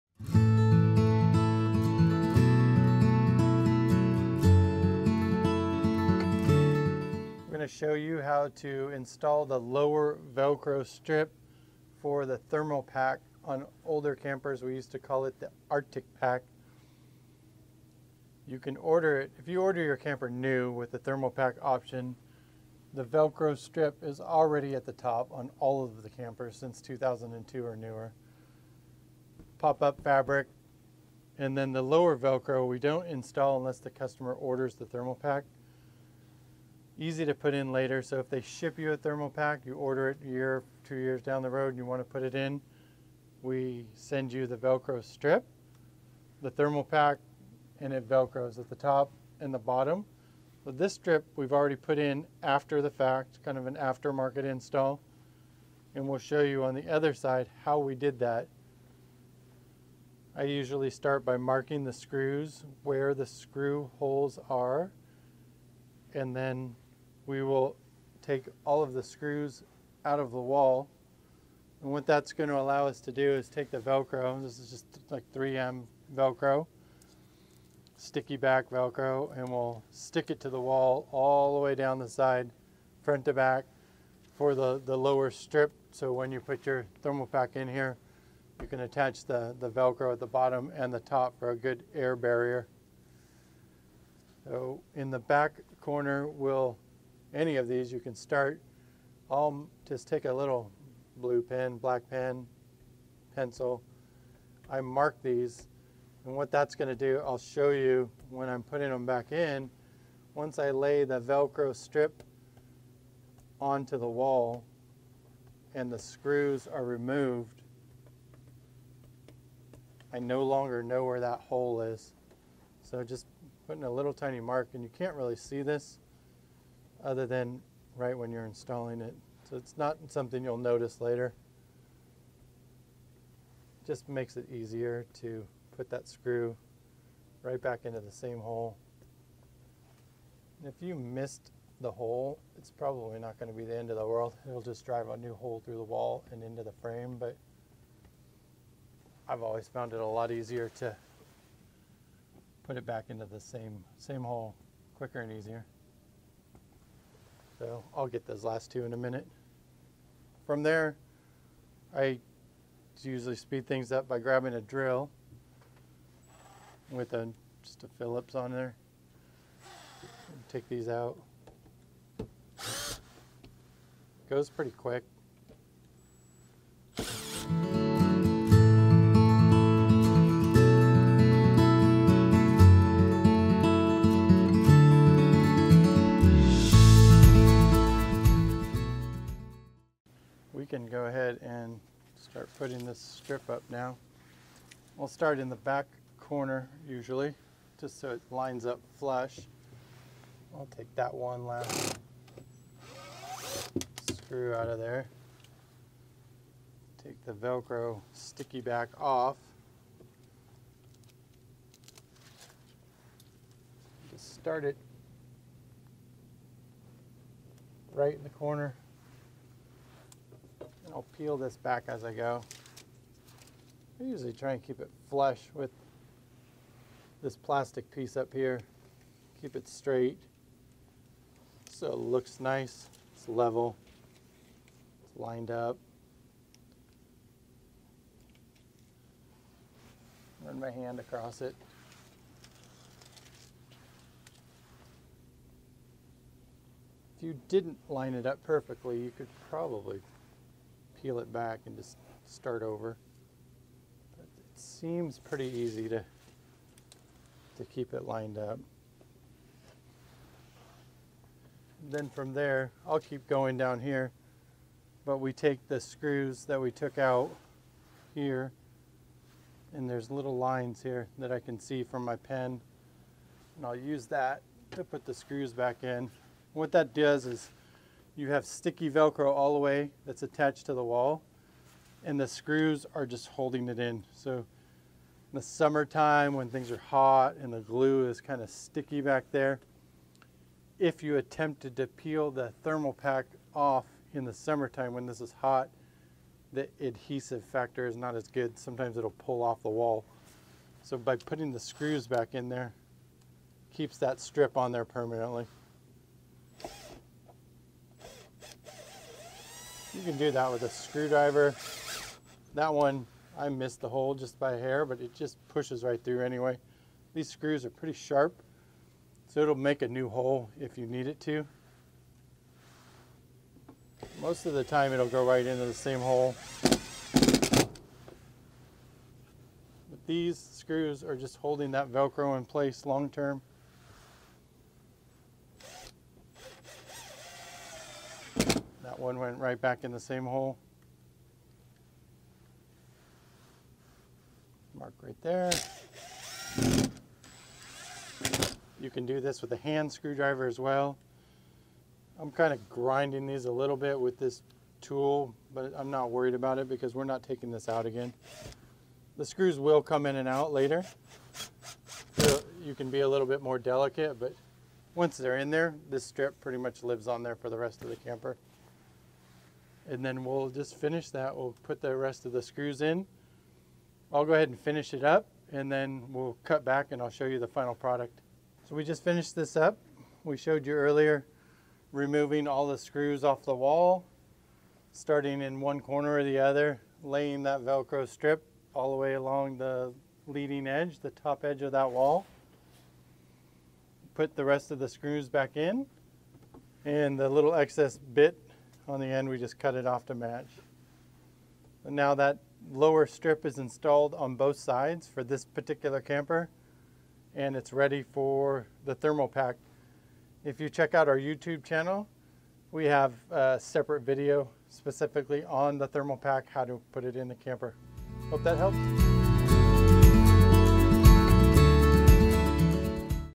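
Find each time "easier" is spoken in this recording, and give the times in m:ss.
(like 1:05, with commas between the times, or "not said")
2:14, 2:30, 2:35.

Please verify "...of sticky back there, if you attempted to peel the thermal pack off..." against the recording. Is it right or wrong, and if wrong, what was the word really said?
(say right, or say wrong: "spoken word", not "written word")
right.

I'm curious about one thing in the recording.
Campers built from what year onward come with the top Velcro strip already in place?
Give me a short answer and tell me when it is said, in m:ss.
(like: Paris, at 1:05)
2002, at 0:26.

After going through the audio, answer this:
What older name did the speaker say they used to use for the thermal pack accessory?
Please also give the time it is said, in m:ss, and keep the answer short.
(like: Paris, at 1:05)
Arctic pack, at 0:15.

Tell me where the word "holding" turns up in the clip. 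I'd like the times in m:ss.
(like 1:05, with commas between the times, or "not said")
4:43, 5:31.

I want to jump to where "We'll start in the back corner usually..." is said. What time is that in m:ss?
3:14.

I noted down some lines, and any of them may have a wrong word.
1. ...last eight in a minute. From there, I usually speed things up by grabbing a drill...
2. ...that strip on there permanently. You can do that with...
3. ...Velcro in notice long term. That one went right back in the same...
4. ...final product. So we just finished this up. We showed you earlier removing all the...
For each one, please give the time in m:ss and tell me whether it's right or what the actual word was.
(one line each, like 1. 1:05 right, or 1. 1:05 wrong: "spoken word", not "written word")
1. 2:38 wrong: "two", not "eight"
2. 5:03 right
3. 5:31 wrong: "place", not "notice"
4. 6:17 right.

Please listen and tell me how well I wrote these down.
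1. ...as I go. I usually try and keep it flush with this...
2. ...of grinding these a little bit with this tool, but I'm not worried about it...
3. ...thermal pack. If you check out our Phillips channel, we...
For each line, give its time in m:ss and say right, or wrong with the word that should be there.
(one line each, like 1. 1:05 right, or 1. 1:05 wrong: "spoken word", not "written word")
1. 3:41 right
2. 5:52 right
3. 6:48 wrong: "YouTube", not "Phillips".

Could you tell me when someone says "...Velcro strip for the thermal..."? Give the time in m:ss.
0:10.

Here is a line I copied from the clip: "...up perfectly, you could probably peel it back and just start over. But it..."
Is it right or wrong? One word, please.
right.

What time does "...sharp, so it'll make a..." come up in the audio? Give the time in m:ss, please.
5:17.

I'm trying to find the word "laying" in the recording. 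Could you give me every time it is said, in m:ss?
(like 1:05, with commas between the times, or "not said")
6:27.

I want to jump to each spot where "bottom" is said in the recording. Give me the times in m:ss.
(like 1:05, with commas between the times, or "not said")
0:49, 1:30.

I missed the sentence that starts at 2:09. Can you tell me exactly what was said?
So it's not something you'll notice later.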